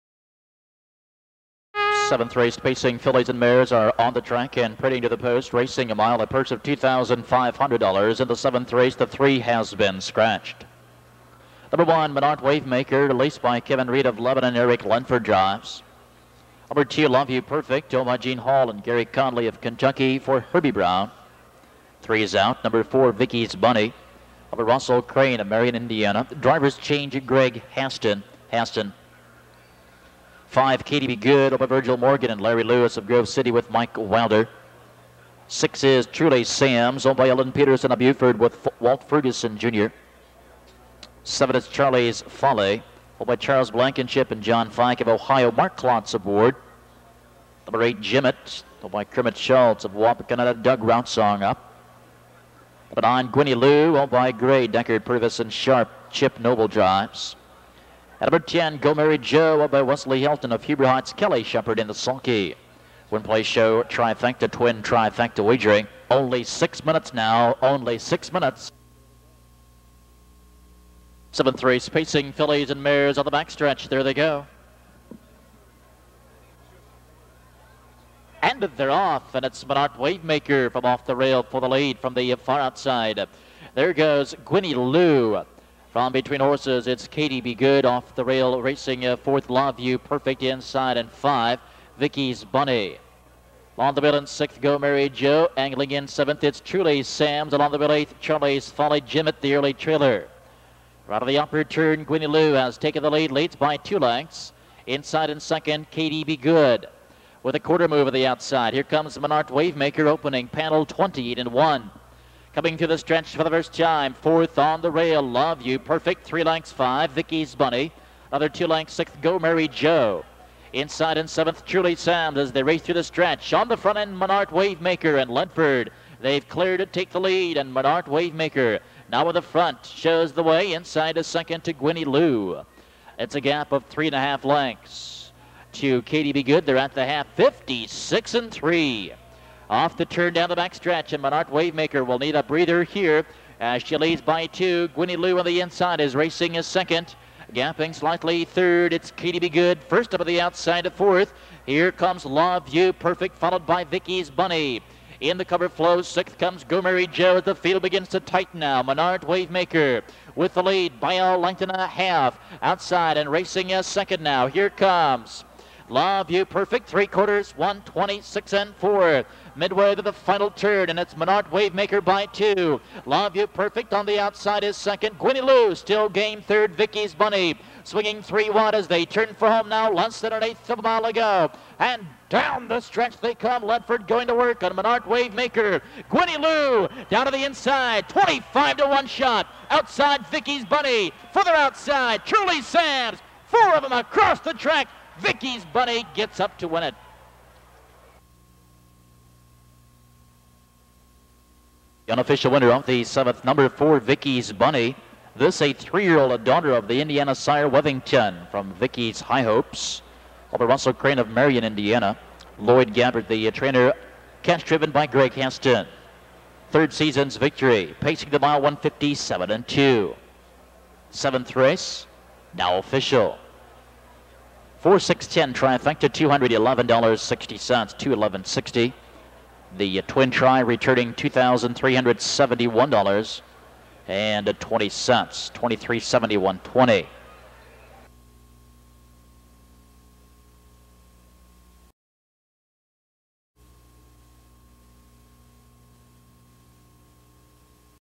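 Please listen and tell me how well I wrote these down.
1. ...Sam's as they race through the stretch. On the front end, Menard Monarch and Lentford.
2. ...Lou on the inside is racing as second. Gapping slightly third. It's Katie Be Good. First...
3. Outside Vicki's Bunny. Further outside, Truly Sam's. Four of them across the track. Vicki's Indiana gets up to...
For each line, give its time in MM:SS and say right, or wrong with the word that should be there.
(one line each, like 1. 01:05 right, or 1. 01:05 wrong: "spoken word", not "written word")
1. 02:01 wrong: "Wavemaker", not "Monarch"
2. 02:25 right
3. 03:09 wrong: "Bunny", not "Indiana".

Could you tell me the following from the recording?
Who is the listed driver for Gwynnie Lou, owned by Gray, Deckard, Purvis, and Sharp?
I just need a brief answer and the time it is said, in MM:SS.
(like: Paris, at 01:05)
Chip Noble, at 00:56.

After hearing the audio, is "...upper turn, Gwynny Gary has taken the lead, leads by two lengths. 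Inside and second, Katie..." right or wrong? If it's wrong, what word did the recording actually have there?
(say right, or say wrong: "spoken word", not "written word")
wrong: "Lou", not "Gary".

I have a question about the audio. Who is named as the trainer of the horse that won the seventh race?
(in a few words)
Lloyd Gabbard.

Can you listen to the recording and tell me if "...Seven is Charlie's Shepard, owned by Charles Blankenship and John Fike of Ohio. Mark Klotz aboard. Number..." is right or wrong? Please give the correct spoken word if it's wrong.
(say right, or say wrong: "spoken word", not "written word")
wrong: "Folly", not "Shepard".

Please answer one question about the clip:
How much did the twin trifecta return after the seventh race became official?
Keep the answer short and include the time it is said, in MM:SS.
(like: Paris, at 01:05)
$2,371.20, at 03:51.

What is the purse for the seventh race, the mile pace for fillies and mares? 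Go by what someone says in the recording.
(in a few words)
$2,500.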